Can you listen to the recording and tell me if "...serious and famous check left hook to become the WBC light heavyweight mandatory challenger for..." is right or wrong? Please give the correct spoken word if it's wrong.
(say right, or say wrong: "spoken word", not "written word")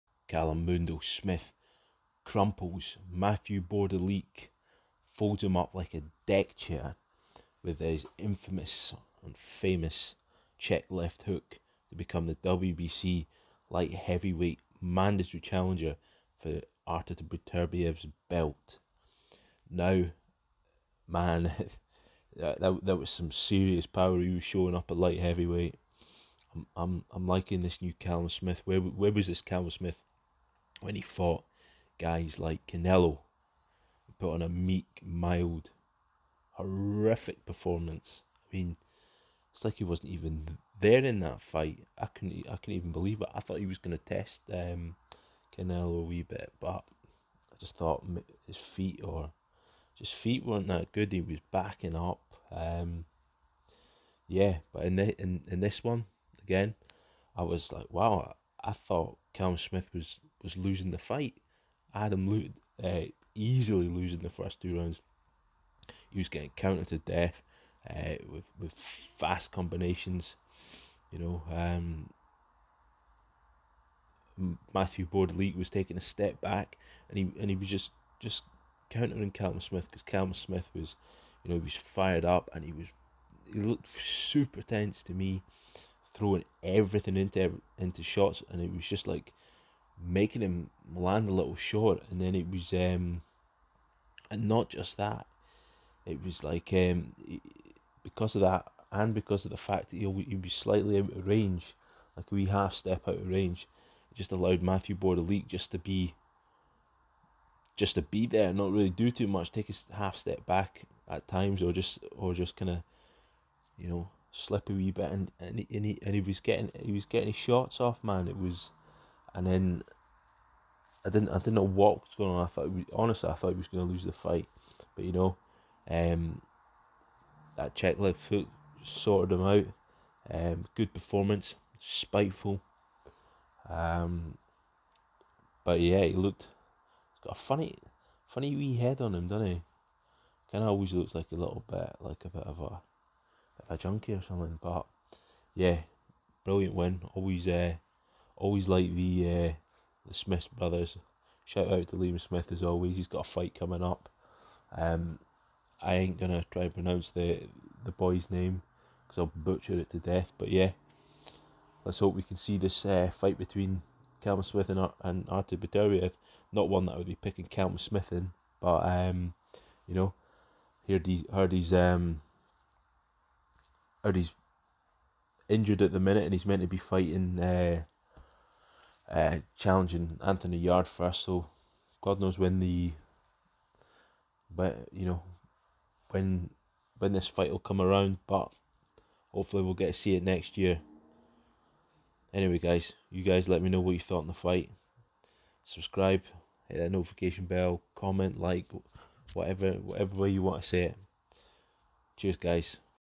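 wrong: "infamous", not "serious".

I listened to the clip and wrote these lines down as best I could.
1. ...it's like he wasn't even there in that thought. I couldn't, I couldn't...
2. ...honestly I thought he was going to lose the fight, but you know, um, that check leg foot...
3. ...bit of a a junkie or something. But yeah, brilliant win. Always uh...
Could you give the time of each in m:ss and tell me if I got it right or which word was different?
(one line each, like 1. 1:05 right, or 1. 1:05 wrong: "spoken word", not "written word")
1. 0:39 wrong: "fight", not "thought"
2. 2:02 right
3. 2:22 right.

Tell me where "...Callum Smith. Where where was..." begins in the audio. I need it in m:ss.
0:27.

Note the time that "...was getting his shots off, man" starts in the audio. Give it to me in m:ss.
1:56.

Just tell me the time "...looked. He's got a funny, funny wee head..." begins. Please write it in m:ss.
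2:16.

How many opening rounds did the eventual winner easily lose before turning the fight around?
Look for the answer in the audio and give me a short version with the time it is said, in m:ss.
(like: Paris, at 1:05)
2, at 1:04.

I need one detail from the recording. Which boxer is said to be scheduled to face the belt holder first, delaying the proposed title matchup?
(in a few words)
Anthony Yarde.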